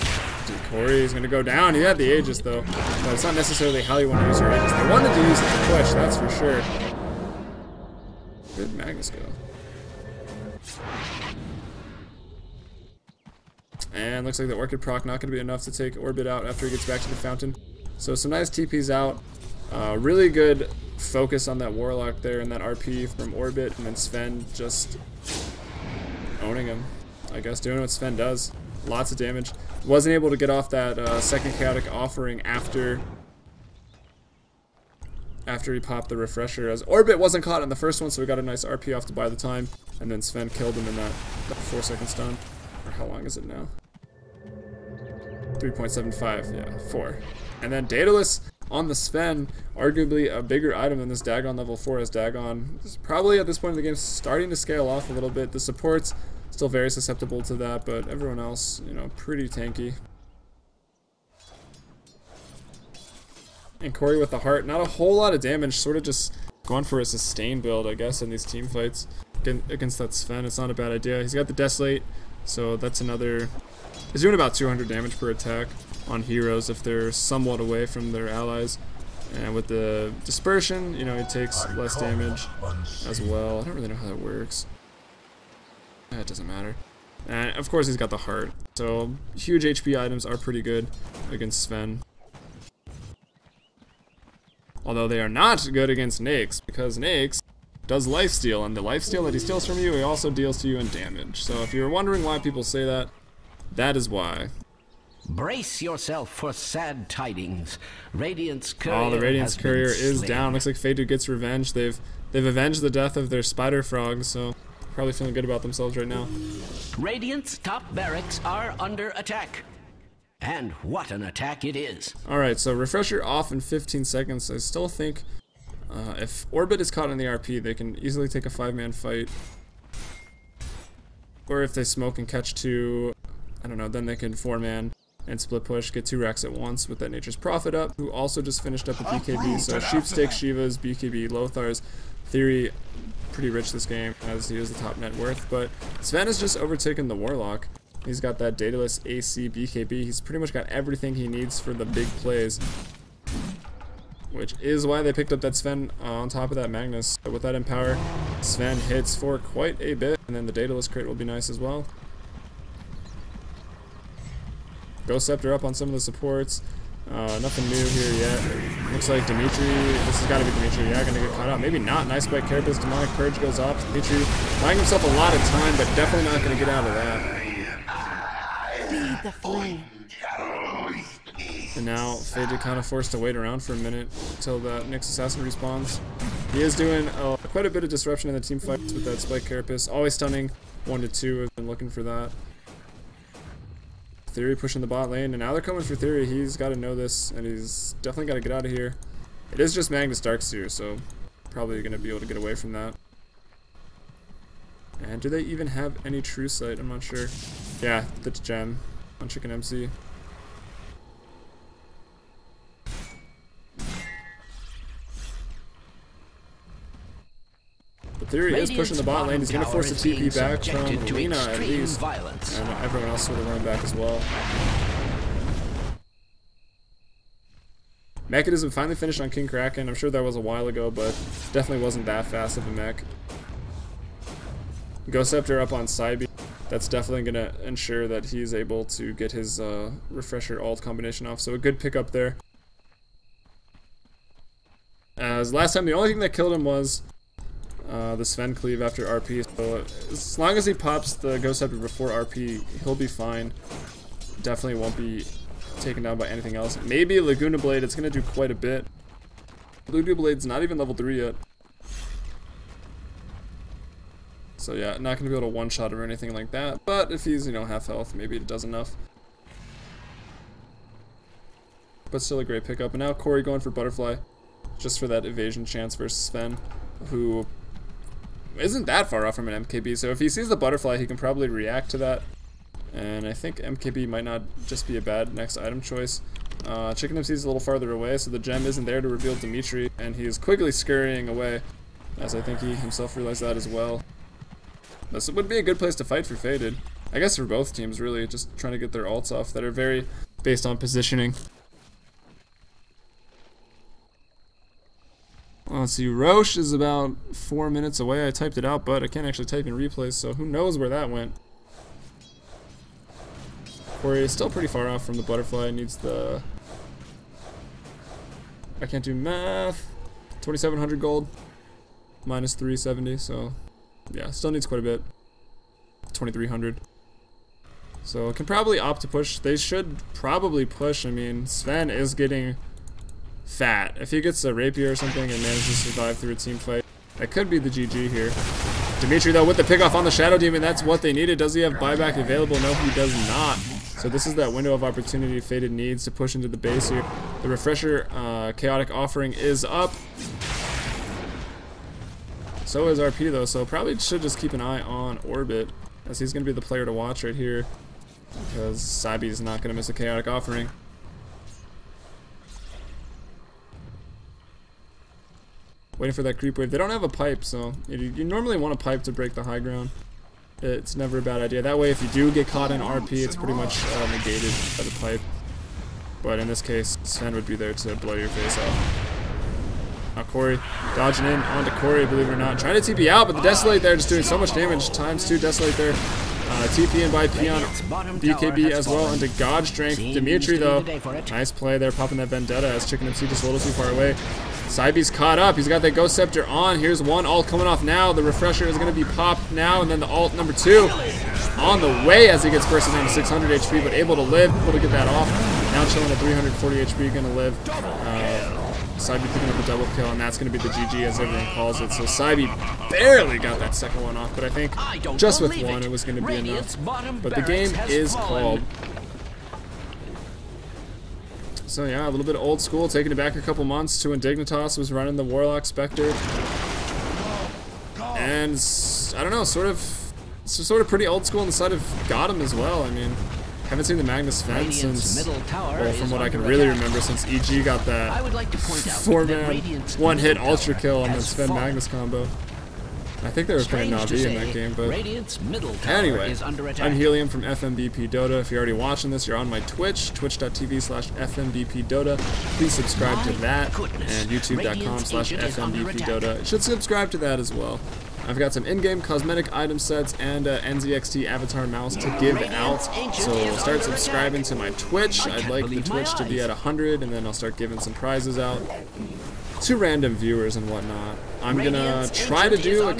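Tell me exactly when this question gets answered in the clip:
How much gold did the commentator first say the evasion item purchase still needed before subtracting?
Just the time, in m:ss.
5:20.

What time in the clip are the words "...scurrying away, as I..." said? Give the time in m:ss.
4:50.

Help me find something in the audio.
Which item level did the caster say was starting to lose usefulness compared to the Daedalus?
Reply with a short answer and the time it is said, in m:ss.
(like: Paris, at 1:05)
Dagon level 4, at 0:51.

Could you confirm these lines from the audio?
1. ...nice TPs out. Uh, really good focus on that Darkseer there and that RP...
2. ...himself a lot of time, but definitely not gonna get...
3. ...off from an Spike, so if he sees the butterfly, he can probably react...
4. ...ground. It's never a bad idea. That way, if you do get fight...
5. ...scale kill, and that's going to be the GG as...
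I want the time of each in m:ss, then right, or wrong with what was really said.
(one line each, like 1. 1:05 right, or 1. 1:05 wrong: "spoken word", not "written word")
1. 0:18 wrong: "Warlock", not "Darkseer"
2. 2:54 right
3. 4:39 wrong: "MKB", not "Spike"
4. 6:09 wrong: "caught", not "fight"
5. 6:49 wrong: "double", not "scale".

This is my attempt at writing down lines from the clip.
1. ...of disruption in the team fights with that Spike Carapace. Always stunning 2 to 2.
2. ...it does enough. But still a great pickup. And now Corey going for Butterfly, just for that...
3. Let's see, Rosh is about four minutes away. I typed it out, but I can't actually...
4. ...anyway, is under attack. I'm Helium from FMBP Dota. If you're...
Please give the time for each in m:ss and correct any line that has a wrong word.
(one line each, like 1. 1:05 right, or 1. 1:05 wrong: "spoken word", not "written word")
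1. 3:07 wrong: "1", not "2"
2. 4:28 right
3. 5:05 right
4. 7:25 right.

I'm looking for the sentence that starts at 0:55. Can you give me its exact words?
The supports Still very susceptible to that, but everyone else, you know, pretty tanky.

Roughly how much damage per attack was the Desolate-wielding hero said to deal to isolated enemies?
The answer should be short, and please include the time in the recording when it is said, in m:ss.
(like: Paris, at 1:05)
200, at 1:14.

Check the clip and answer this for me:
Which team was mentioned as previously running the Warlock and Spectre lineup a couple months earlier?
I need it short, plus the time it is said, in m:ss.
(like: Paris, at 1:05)
Dignitas, at 7:04.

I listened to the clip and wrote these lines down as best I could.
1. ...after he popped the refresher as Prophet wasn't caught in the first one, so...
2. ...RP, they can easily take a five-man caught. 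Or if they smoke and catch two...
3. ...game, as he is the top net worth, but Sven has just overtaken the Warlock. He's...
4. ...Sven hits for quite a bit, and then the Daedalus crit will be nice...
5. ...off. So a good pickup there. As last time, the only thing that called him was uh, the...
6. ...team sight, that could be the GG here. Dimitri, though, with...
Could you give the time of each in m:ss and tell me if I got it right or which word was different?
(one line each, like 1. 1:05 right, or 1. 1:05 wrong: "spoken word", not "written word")
1. 0:35 wrong: "Orbit", not "Prophet"
2. 2:07 wrong: "fight", not "caught"
3. 2:23 right
4. 2:38 right
5. 4:01 wrong: "killed", not "called"
6. 5:36 wrong: "fight", not "sight".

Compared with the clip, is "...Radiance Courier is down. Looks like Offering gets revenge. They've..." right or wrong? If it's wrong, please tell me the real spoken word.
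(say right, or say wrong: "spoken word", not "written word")
wrong: "Faded", not "Offering".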